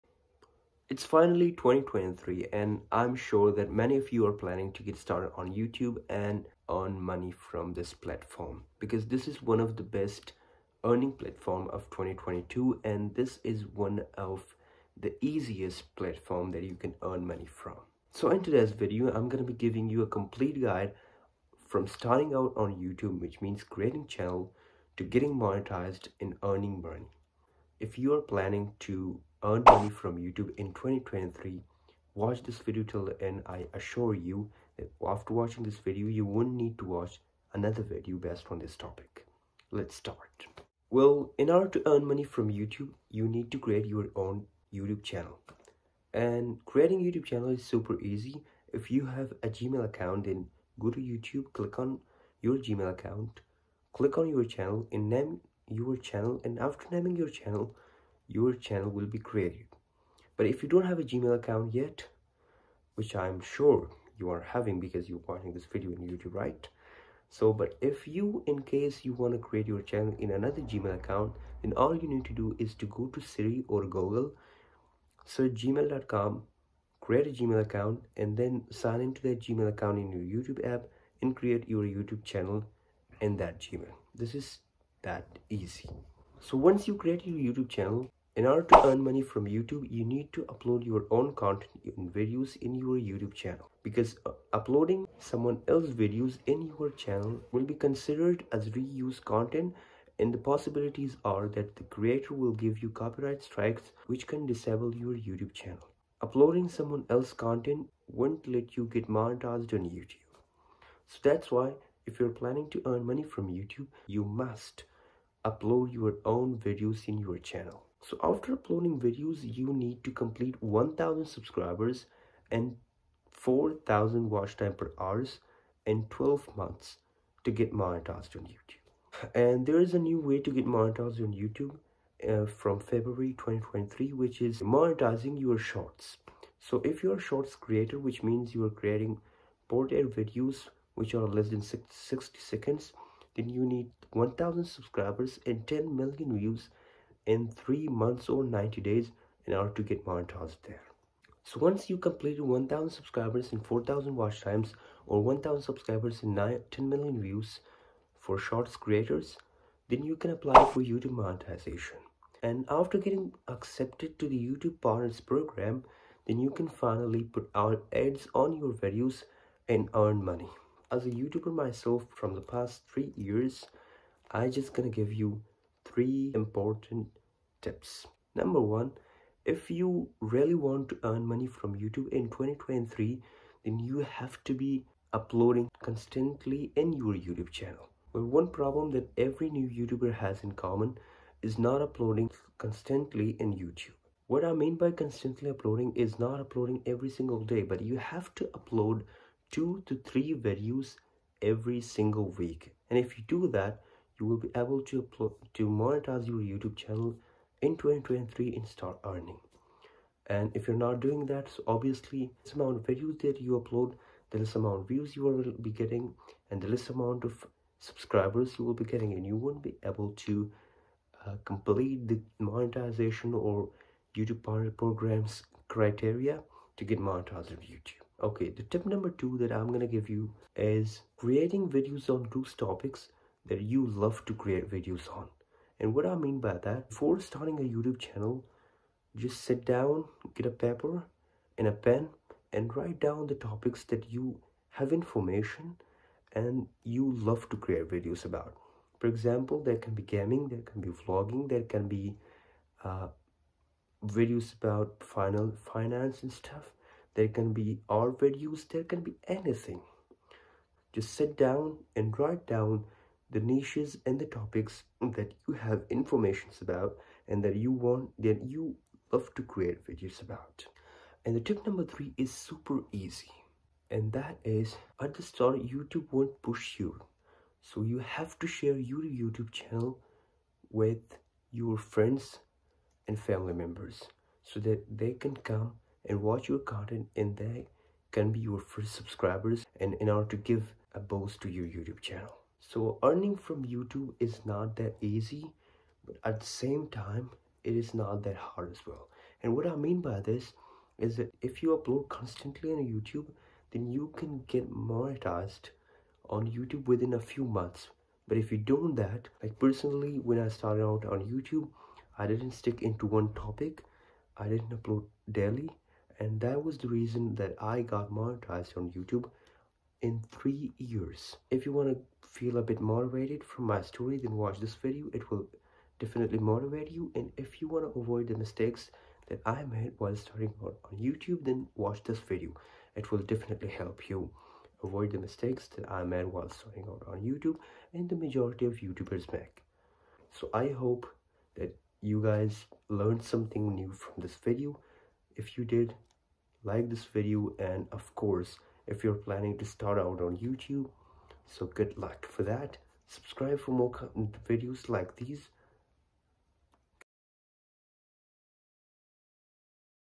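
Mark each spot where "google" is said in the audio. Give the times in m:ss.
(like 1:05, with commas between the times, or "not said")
1:13.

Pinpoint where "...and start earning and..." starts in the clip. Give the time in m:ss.
3:28.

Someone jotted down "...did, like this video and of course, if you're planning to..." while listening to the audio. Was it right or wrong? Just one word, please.
right.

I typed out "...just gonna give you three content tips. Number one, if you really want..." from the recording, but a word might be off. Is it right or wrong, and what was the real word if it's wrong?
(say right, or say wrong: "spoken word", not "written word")
wrong: "important", not "content".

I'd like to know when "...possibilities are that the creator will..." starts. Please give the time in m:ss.
1:40.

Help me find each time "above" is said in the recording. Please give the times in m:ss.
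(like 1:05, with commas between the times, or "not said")
not said.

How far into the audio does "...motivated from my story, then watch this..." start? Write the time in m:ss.
5:22.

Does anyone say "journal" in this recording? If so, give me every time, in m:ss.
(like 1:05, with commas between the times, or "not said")
not said.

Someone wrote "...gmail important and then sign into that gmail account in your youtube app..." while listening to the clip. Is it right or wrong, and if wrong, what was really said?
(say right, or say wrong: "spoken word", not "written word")
wrong: "account", not "important".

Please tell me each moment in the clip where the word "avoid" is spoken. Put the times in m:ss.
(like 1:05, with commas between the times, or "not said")
5:27, 5:34.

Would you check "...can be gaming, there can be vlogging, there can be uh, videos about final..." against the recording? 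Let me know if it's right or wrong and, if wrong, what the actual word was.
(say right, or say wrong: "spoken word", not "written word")
right.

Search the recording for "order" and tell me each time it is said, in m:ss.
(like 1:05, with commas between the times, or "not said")
0:41, 1:28, 2:29, 4:50.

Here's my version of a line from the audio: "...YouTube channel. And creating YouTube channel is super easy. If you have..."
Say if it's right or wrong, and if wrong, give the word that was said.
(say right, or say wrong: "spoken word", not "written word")
right.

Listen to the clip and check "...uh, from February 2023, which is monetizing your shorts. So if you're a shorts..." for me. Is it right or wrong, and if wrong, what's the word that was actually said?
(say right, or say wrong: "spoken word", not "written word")
right.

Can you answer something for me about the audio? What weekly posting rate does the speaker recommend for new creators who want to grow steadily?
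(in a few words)
2 to 3 videos.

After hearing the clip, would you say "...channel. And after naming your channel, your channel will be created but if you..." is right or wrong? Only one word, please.
right.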